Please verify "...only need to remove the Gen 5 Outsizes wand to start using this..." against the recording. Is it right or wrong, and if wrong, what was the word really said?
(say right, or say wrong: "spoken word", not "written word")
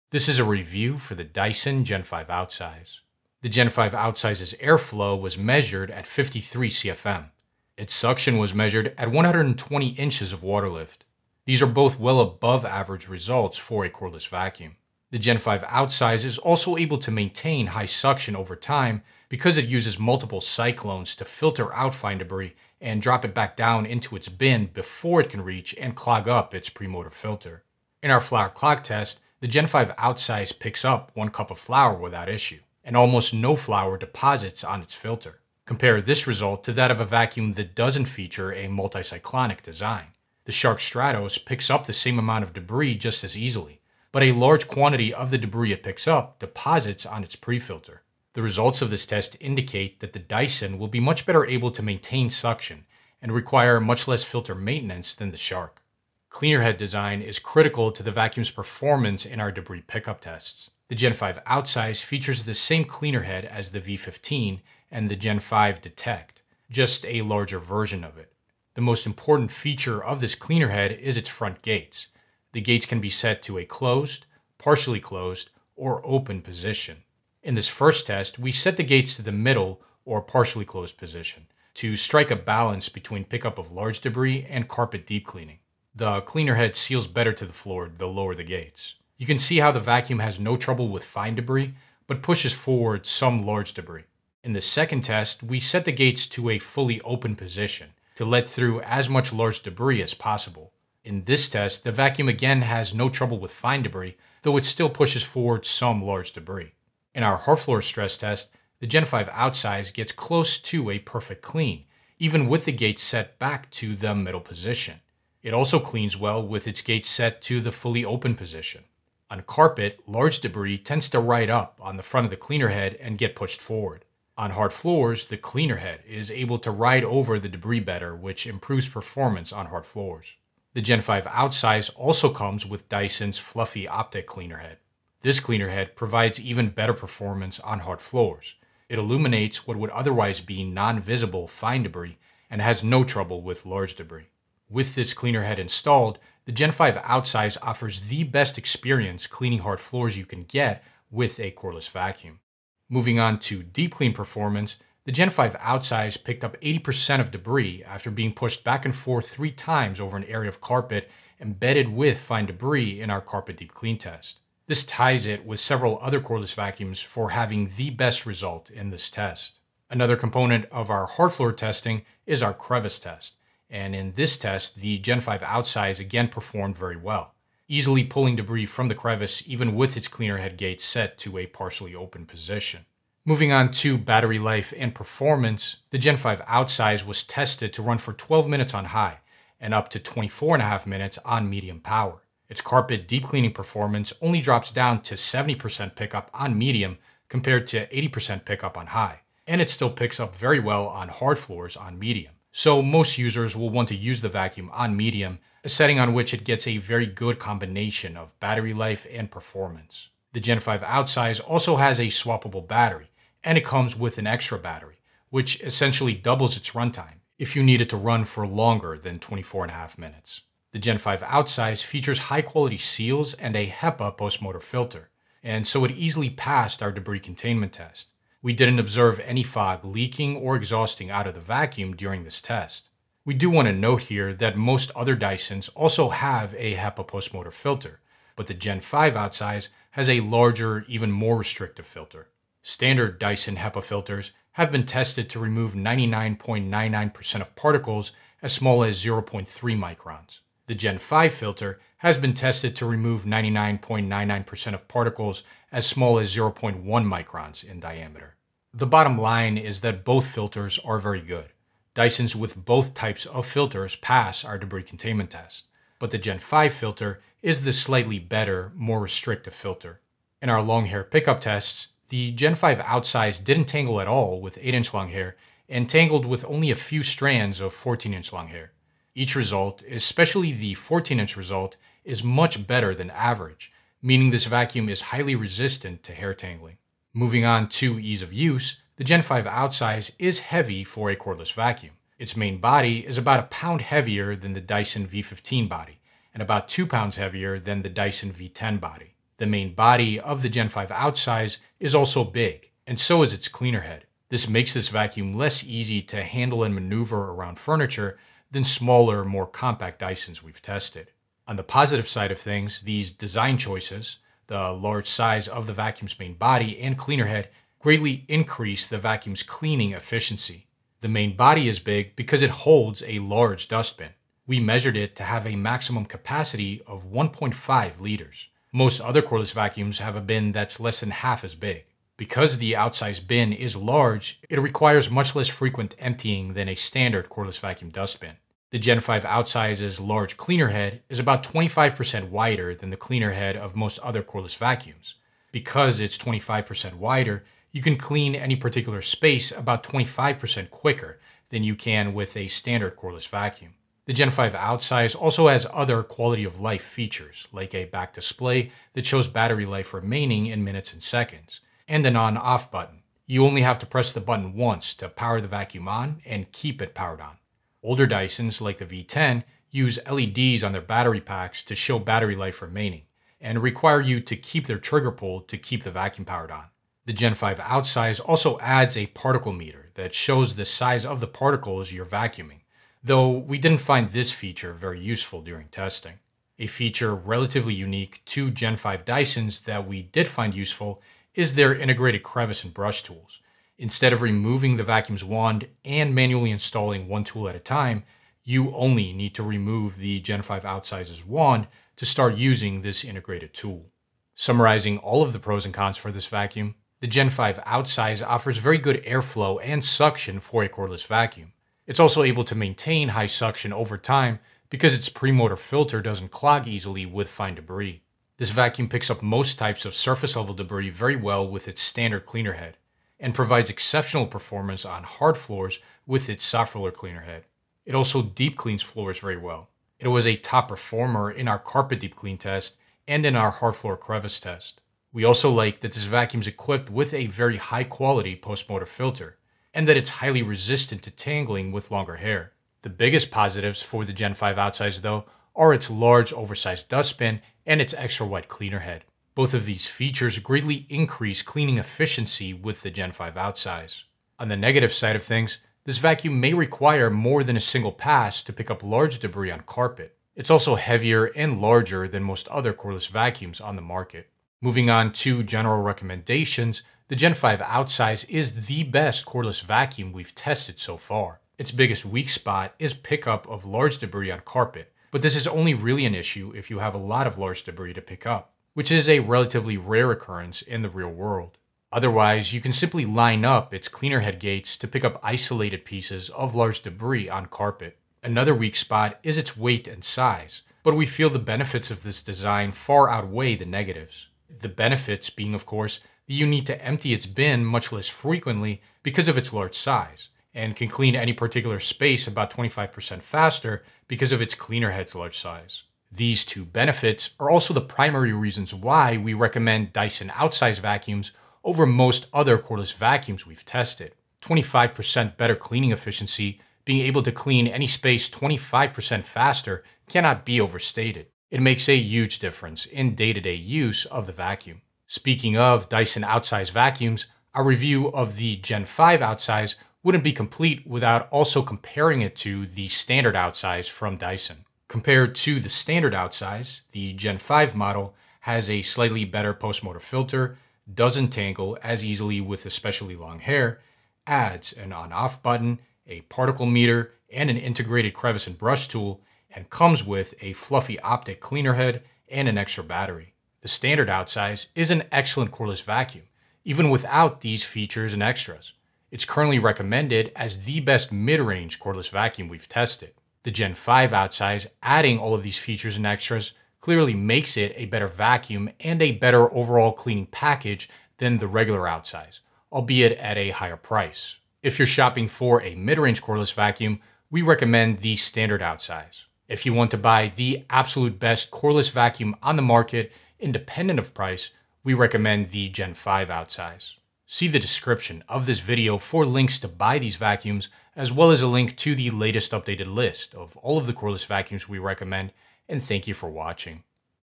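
right.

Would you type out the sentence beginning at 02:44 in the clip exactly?
This ties it with several other cordless vacuums for having the best result in this test.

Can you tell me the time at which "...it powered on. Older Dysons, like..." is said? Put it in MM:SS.
06:06.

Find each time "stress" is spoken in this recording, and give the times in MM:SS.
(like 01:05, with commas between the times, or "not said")
01:47.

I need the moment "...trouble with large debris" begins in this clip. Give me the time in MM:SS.
02:23.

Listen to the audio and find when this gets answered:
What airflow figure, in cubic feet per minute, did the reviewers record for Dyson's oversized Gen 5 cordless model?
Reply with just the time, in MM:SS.
00:06.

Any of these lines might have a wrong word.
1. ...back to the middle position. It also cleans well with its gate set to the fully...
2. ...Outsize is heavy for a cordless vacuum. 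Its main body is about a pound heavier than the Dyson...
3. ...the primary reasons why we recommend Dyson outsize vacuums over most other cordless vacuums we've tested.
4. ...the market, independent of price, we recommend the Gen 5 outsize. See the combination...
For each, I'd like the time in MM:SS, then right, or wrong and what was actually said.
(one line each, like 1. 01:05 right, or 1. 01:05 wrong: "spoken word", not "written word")
1. 01:53 right
2. 04:49 right
3. 08:27 right
4. 09:42 wrong: "description", not "combination".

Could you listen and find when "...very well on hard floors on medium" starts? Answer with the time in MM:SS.
03:20.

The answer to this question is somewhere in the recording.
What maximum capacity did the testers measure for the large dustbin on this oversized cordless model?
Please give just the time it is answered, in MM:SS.
05:27.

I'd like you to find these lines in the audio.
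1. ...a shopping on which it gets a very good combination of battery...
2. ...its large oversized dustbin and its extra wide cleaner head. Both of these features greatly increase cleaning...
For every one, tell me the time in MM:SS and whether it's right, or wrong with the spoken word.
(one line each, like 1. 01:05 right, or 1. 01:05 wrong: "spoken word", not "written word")
1. 03:25 wrong: "setting", not "shopping"
2. 07:25 right.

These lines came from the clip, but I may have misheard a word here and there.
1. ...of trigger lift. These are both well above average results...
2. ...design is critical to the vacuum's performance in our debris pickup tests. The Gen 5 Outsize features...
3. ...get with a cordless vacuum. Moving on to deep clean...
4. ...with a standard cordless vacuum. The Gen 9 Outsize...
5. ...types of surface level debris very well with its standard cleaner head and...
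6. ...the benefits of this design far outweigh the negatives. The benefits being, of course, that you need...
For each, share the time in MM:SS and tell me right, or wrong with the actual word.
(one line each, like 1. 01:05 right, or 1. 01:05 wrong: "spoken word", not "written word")
1. 00:10 wrong: "water", not "trigger"
2. 00:56 right
3. 02:30 right
4. 05:52 wrong: "5", not "9"
5. 06:59 right
6. 08:11 right.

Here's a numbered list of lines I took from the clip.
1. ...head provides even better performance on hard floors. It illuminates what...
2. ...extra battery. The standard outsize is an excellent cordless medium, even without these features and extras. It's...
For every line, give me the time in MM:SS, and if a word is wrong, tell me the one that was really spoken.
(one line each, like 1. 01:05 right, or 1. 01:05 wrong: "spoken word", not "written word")
1. 02:15 right
2. 09:12 wrong: "vacuum", not "medium".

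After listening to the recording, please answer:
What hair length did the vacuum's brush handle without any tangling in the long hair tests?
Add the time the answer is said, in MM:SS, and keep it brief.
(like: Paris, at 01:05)
8 inches, at 04:34.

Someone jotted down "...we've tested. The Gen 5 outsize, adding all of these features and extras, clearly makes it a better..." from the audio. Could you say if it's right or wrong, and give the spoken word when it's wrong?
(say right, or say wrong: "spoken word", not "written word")
right.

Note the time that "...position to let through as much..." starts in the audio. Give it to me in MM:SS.
01:37.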